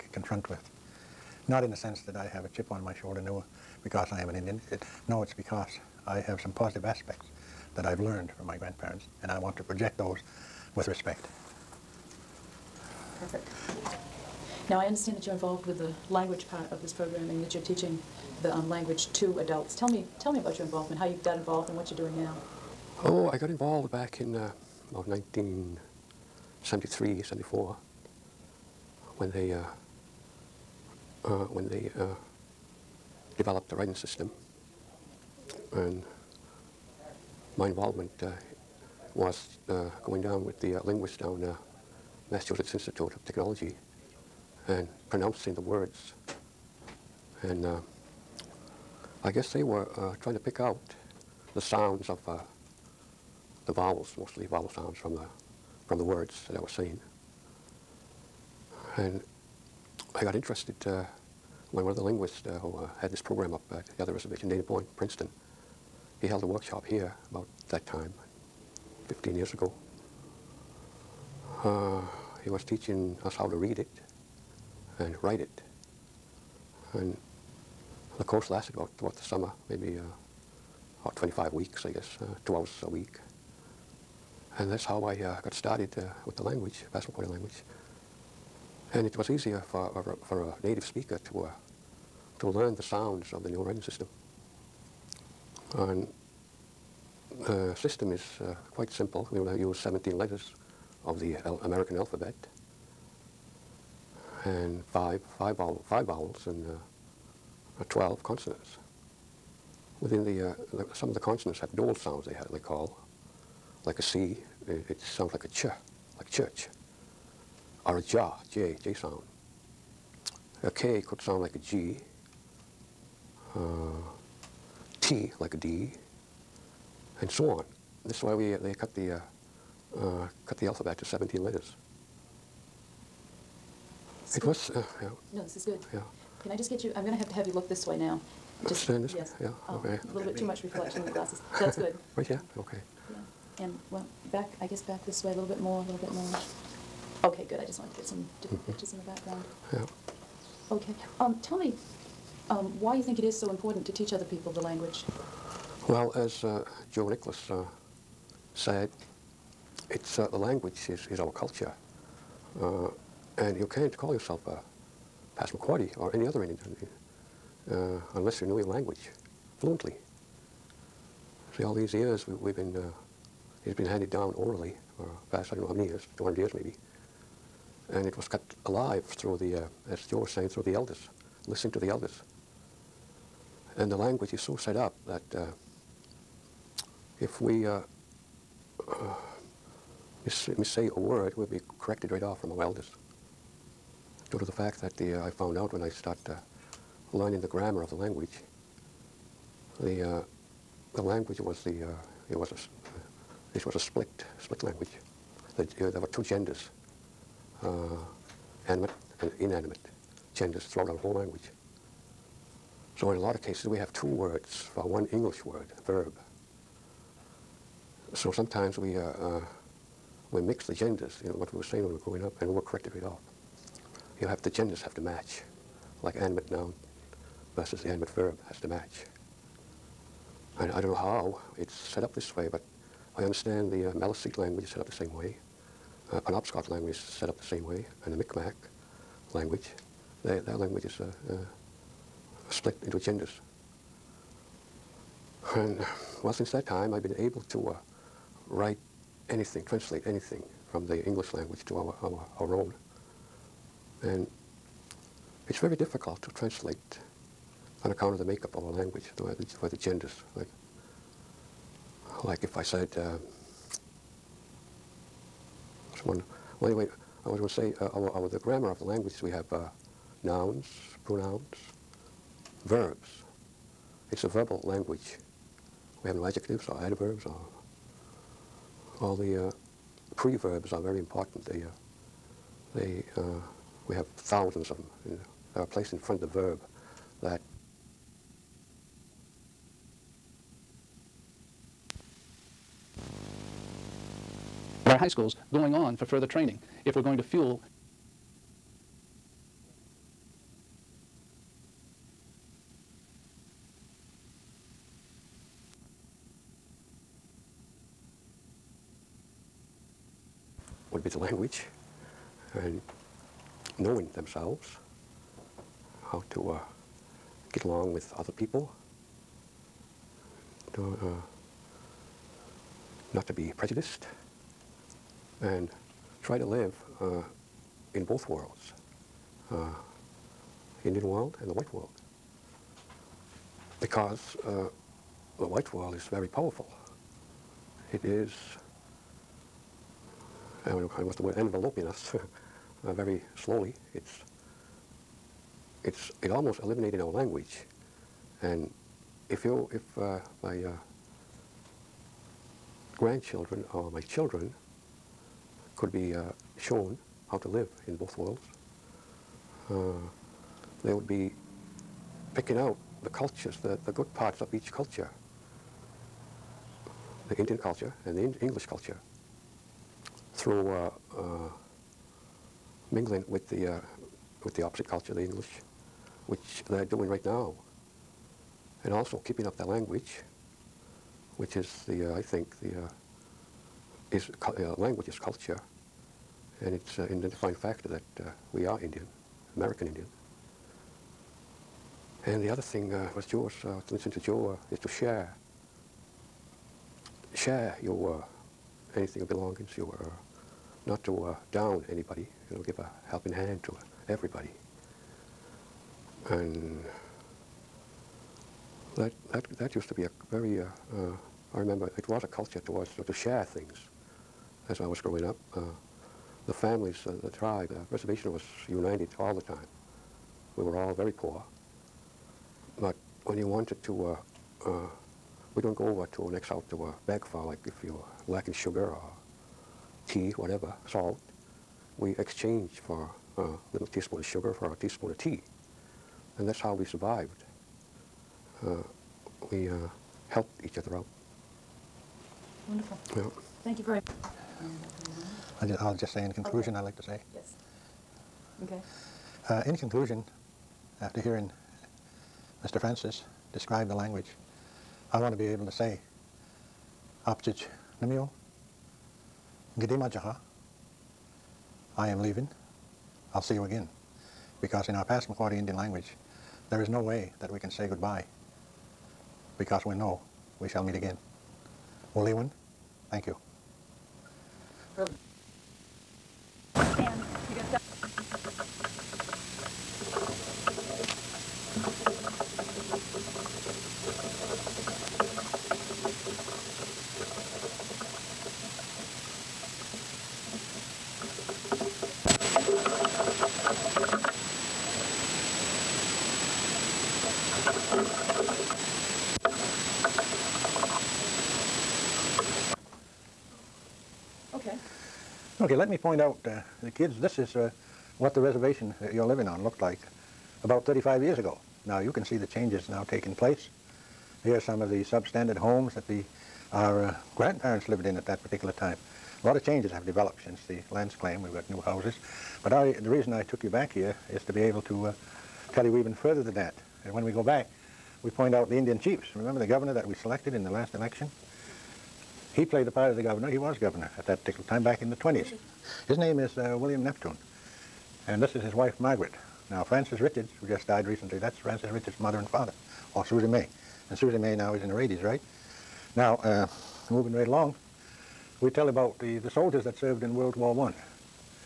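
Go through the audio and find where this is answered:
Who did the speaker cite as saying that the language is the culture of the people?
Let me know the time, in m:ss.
2:36.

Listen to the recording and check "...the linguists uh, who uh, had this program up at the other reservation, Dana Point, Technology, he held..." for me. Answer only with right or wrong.
wrong.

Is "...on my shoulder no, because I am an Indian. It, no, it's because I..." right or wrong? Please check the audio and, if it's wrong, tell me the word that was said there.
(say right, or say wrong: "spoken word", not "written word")
right.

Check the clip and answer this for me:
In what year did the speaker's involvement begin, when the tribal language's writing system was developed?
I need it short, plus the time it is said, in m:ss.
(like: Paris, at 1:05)
1973, at 0:25.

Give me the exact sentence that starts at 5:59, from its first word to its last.
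Uh, they would be picking out the cultures, the, the good parts of each culture.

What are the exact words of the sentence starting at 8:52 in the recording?
He played the part of the governor.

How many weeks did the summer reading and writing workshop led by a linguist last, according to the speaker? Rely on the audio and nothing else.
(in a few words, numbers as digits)
25.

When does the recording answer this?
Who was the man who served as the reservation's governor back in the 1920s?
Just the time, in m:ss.
8:56.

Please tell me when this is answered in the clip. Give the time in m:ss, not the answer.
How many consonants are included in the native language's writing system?
1:47.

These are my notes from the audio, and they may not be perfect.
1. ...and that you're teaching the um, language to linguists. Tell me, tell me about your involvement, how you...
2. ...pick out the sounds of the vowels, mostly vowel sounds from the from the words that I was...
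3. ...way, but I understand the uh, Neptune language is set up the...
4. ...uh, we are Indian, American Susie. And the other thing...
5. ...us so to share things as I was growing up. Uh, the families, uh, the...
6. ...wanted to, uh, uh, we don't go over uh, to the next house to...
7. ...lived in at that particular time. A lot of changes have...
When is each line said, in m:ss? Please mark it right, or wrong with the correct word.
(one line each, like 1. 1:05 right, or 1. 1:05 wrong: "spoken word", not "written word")
1. 0:17 wrong: "adults", not "linguists"
2. 0:50 right
3. 3:52 wrong: "Maliseet", not "Neptune"
4. 6:28 wrong: "Indian", not "Susie"
5. 6:52 right
6. 7:03 right
7. 8:37 right.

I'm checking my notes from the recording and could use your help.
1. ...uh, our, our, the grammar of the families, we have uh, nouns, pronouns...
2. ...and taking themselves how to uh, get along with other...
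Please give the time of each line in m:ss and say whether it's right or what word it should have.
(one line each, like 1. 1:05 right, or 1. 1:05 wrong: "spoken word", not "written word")
1. 4:27 wrong: "languages", not "families"
2. 5:12 wrong: "knowing", not "taking".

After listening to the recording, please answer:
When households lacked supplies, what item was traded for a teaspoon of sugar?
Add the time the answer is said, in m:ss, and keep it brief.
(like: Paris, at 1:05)
a teaspoon of tea, at 7:14.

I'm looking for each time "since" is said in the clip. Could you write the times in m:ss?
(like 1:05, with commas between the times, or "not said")
4:06, 8:40.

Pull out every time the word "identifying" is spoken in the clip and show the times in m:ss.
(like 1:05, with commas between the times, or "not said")
6:27.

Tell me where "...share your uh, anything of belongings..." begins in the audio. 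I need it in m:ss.
6:37.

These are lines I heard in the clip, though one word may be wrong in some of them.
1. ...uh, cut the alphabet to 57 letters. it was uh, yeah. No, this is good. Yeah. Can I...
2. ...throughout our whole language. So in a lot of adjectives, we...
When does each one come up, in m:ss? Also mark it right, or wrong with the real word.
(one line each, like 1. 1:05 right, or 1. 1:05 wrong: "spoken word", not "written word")
1. 2:09 wrong: "17", not "57"
2. 3:30 wrong: "cases", not "adjectives".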